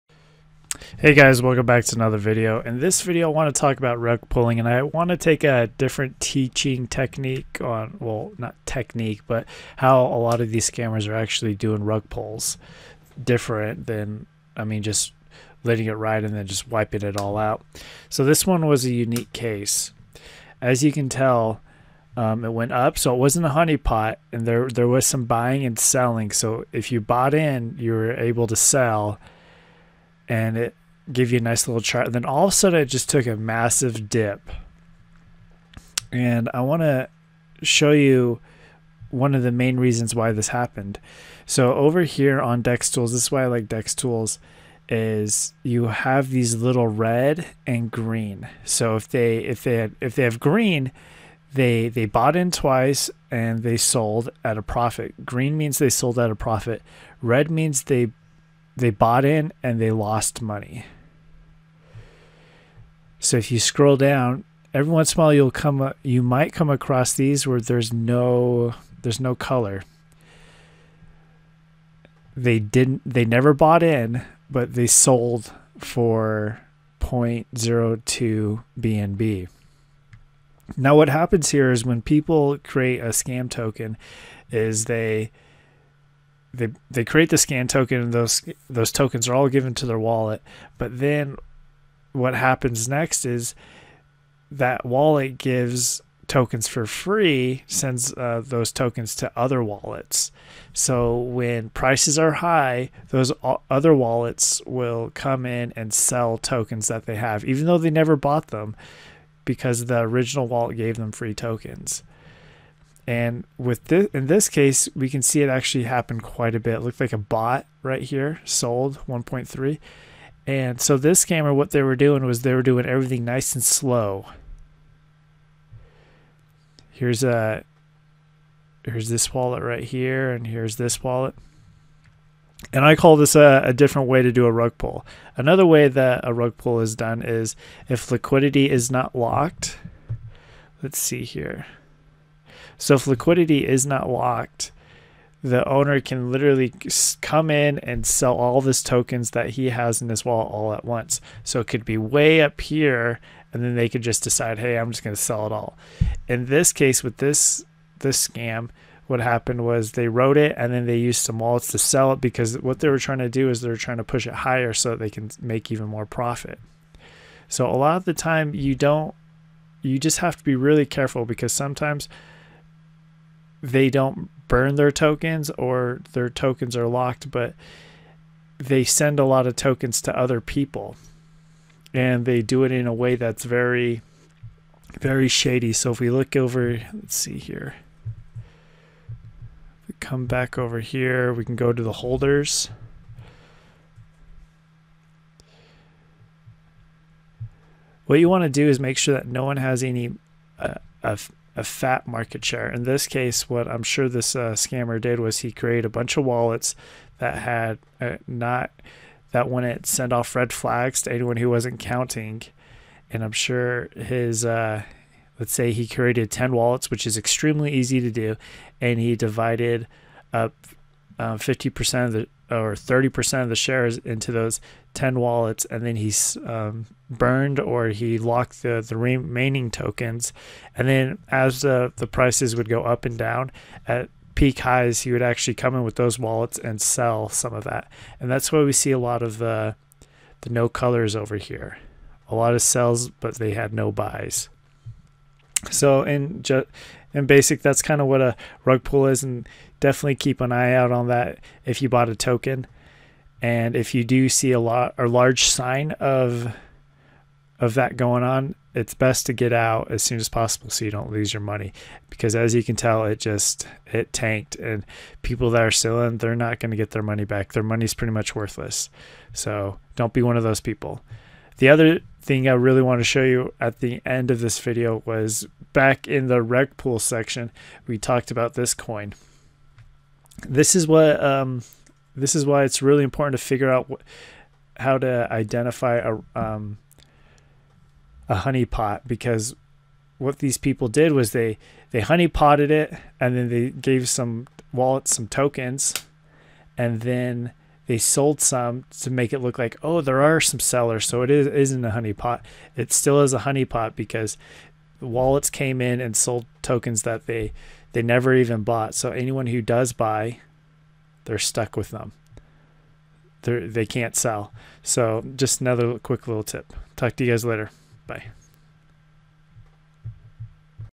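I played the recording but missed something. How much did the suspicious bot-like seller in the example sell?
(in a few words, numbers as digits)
1.3.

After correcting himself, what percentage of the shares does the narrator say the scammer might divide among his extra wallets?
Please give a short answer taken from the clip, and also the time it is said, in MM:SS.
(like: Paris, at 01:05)
30%, at 03:42.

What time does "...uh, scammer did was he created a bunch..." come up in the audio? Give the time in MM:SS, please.
03:24.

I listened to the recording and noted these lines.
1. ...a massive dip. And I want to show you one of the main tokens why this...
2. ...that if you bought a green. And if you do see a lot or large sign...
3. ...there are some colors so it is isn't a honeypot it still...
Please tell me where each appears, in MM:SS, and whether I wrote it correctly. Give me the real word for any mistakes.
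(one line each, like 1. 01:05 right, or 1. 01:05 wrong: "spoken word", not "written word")
1. 00:33 wrong: "reasons", not "tokens"
2. 04:11 wrong: "token", not "green"
3. 05:00 wrong: "sellers", not "colors".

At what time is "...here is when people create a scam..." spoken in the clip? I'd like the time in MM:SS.
01:21.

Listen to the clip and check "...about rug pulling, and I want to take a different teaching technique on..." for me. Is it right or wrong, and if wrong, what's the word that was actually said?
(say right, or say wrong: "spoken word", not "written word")
right.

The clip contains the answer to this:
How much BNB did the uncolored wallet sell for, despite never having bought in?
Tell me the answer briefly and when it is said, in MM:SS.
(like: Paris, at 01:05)
0.02 BNB, at 01:16.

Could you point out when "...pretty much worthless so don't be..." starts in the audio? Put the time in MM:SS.
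04:27.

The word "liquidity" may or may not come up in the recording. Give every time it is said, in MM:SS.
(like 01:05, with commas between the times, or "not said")
02:18, 02:23.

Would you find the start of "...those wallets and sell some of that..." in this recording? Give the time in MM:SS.
03:55.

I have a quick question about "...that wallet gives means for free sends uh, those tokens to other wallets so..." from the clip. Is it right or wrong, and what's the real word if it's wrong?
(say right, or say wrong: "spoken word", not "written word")
wrong: "tokens", not "means".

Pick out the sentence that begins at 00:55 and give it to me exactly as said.
Green means they sold at a profit.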